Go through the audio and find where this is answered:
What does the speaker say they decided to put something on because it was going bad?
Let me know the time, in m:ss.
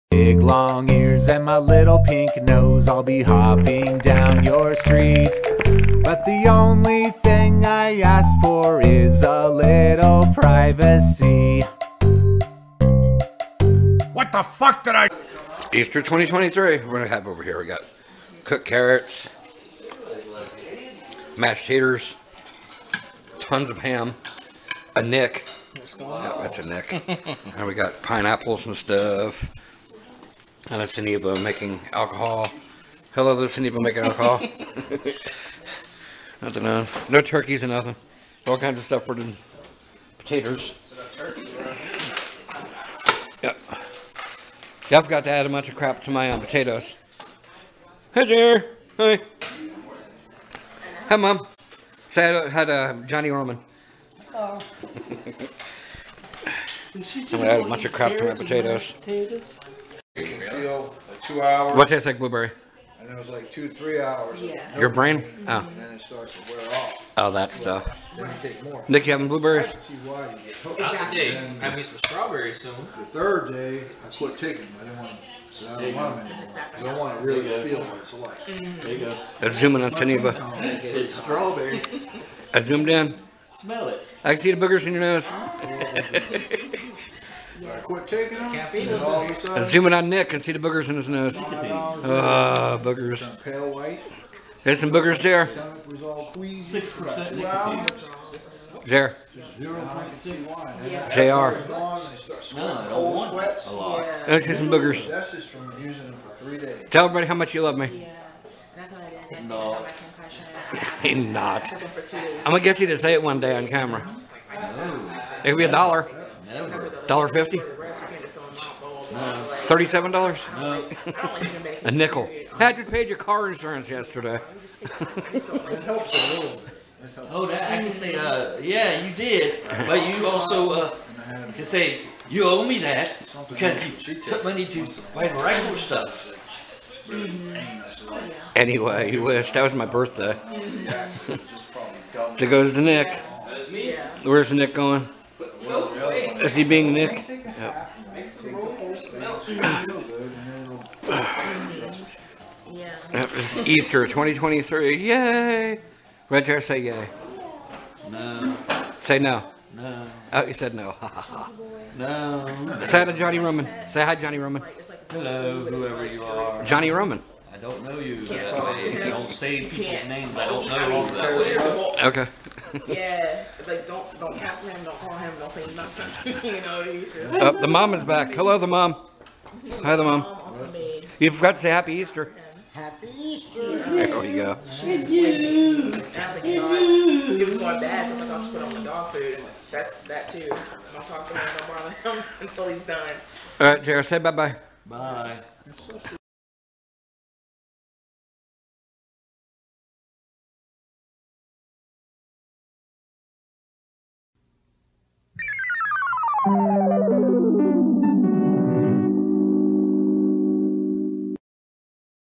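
3:08.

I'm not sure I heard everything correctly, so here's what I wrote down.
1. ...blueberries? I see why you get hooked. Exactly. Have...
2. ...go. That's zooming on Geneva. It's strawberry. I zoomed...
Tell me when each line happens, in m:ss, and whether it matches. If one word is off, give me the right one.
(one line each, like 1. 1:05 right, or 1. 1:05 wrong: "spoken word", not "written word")
1. 1:09 right
2. 1:18 right.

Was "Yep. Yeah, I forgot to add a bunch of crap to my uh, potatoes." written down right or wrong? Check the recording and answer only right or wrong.
right.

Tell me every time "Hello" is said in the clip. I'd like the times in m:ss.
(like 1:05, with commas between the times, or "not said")
0:33, 2:45, 2:58.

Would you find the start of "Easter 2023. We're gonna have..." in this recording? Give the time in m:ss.
0:15.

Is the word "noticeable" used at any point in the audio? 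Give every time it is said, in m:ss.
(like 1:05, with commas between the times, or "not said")
not said.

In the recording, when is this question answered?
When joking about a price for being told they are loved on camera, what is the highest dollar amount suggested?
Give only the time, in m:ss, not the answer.
1:59.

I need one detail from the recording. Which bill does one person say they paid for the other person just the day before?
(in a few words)
car insurance.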